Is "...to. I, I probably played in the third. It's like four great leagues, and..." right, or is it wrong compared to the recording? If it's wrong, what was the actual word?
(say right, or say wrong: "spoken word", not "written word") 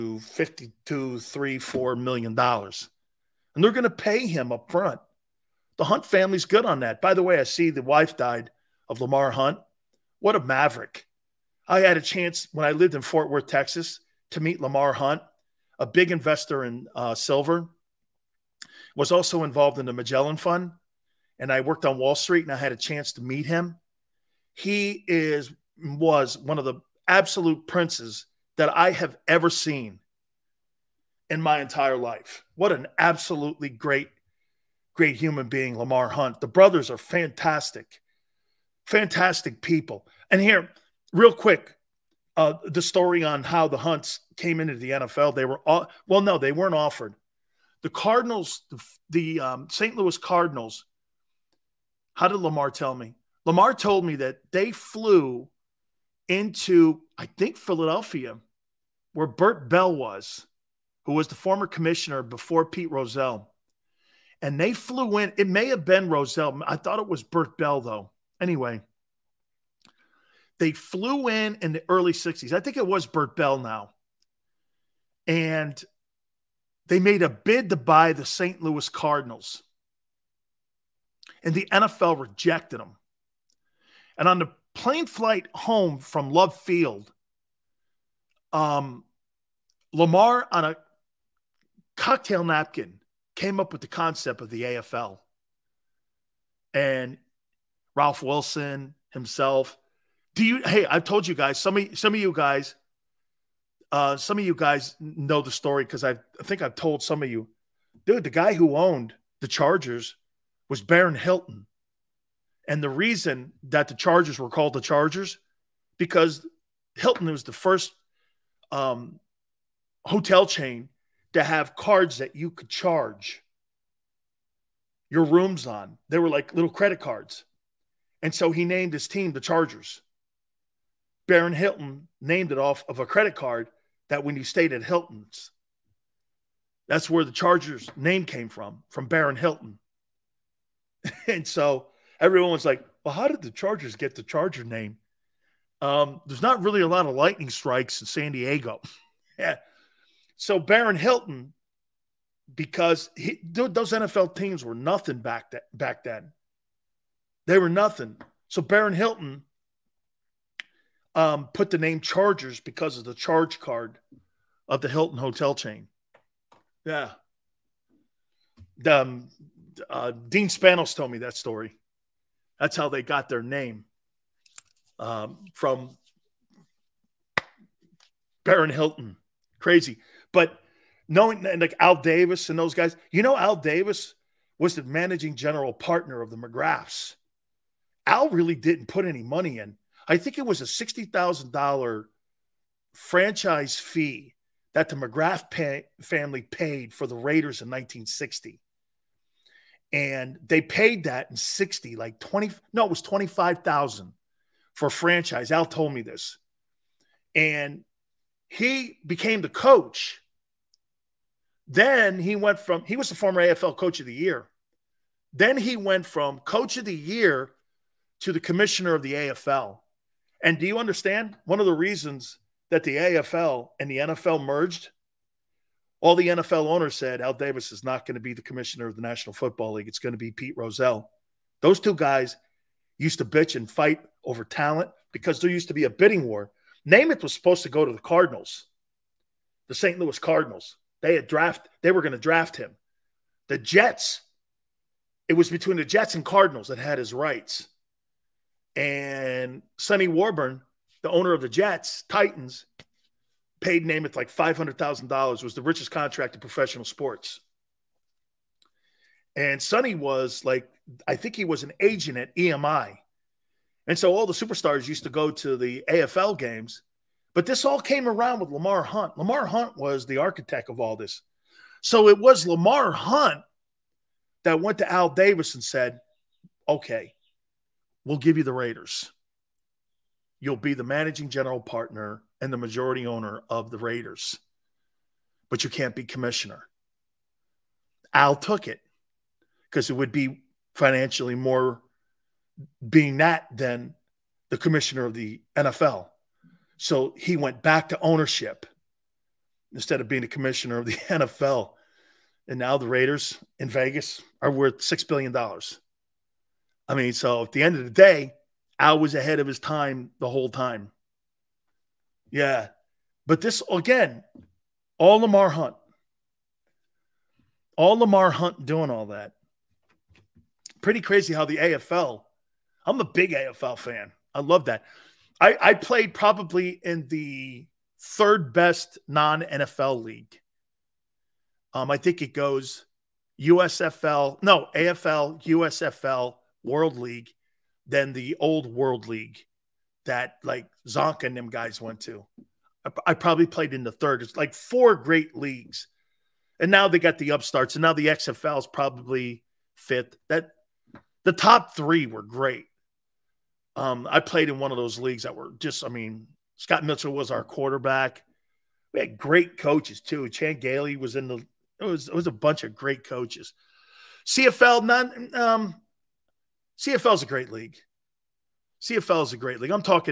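right.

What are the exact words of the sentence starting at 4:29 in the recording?
Lamar Hunt was the architect of all this.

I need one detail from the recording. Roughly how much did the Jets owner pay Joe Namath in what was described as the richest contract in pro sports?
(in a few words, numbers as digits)
$500,000.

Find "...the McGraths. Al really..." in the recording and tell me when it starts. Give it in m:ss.
3:06.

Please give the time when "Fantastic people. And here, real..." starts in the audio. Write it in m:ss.
0:38.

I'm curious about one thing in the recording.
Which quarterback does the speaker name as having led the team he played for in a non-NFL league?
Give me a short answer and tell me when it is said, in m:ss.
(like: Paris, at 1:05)
Scott Mitchell, at 5:56.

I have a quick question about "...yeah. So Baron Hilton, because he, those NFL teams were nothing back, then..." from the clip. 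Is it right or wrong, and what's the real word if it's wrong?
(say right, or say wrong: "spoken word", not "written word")
right.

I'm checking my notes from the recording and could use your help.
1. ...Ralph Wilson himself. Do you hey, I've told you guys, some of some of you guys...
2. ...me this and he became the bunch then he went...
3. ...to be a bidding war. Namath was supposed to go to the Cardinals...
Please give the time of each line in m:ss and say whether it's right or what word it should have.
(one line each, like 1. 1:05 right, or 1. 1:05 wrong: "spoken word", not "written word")
1. 1:37 right
2. 3:25 wrong: "coach", not "bunch"
3. 3:55 right.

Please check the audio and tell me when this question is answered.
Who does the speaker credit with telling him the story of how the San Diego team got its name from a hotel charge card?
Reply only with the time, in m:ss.
2:50.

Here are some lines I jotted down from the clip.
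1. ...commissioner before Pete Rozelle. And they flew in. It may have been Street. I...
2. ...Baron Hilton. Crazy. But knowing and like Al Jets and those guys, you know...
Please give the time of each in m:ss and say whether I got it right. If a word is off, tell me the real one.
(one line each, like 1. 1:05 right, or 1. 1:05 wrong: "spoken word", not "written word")
1. 1:01 wrong: "Rozelle", not "Street"
2. 2:58 wrong: "Davis", not "Jets".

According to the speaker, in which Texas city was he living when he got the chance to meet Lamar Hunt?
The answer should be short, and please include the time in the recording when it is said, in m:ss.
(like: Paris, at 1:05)
Fort Worth, at 0:13.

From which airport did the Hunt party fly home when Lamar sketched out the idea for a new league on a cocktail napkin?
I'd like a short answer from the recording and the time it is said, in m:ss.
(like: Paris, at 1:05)
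Love Field, at 1:26.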